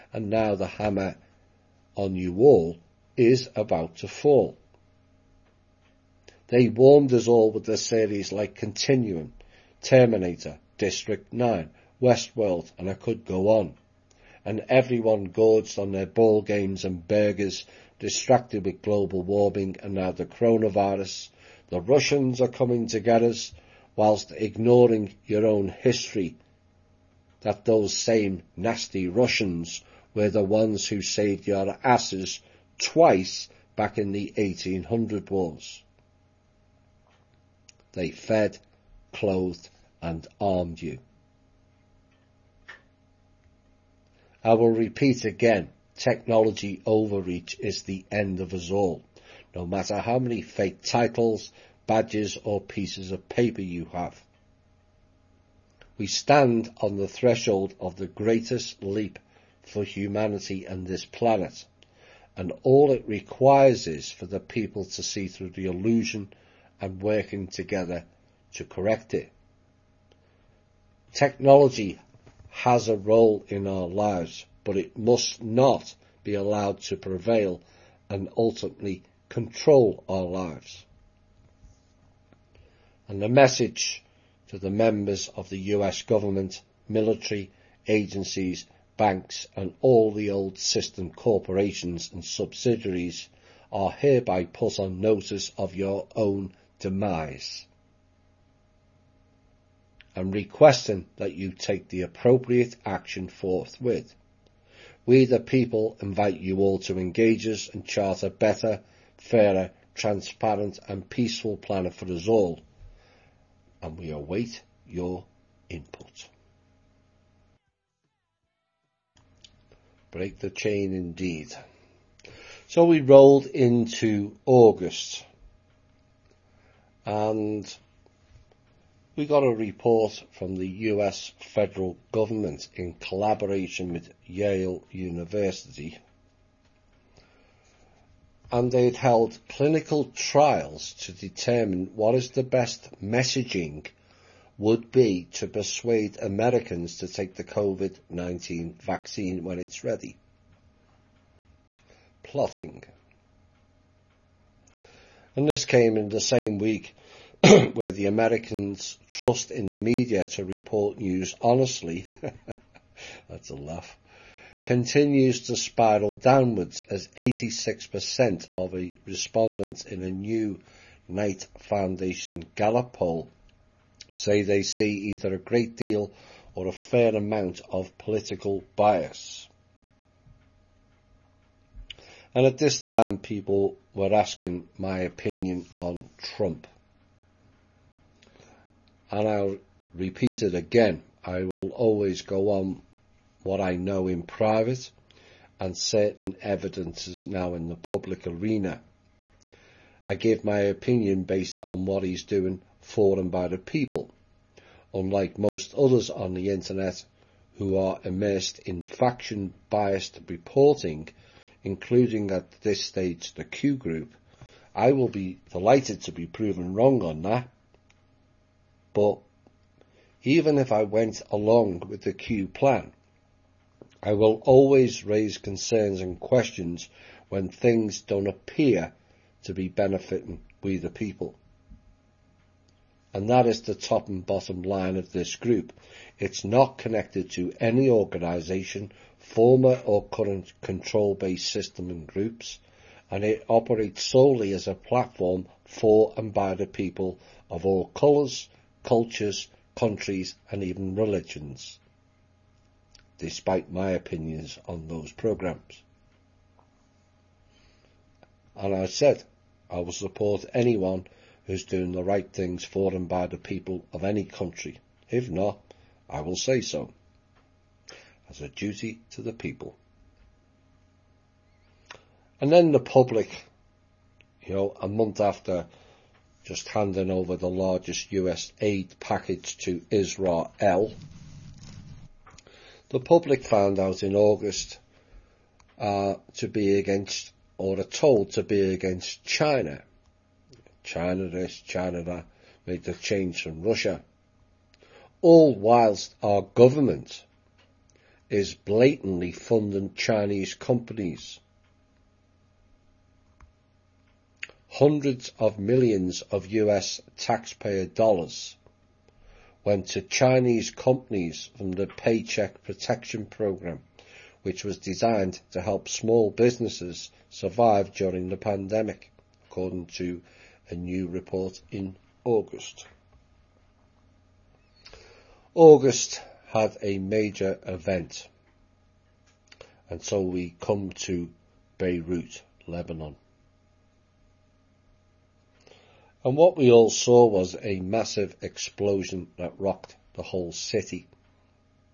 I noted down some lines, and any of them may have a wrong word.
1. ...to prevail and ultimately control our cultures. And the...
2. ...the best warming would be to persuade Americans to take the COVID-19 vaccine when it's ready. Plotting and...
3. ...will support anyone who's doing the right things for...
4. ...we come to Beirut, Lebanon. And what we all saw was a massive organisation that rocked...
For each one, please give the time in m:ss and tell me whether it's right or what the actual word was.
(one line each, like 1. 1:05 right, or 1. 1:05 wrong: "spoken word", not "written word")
1. 1:16 wrong: "lives", not "cultures"
2. 2:22 wrong: "messaging", not "warming"
3. 4:19 right
4. 5:30 wrong: "explosion", not "organisation".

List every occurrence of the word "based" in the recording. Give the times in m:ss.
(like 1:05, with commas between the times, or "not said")
3:21, 4:00.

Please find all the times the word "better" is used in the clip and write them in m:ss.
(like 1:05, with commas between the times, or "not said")
1:48.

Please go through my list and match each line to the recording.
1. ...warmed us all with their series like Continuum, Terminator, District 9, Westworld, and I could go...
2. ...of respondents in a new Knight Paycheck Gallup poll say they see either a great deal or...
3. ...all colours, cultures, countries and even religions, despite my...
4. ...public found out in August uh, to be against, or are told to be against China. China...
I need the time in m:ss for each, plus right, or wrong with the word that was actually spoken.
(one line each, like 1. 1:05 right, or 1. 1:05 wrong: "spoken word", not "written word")
1. 0:06 right
2. 2:48 wrong: "Foundation", not "Paycheck"
3. 4:07 right
4. 4:42 right.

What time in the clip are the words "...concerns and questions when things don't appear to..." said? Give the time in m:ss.
3:45.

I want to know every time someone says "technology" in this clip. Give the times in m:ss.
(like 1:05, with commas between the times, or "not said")
0:45, 1:11.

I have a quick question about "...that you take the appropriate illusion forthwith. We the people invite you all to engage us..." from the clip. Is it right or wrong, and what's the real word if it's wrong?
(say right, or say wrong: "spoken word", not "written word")
wrong: "action", not "illusion".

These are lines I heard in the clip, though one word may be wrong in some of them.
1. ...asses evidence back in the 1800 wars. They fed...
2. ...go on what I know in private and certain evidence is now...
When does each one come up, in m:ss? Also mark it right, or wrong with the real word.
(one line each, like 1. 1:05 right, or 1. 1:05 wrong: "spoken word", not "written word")
1. 0:31 wrong: "twice", not "evidence"
2. 3:12 right.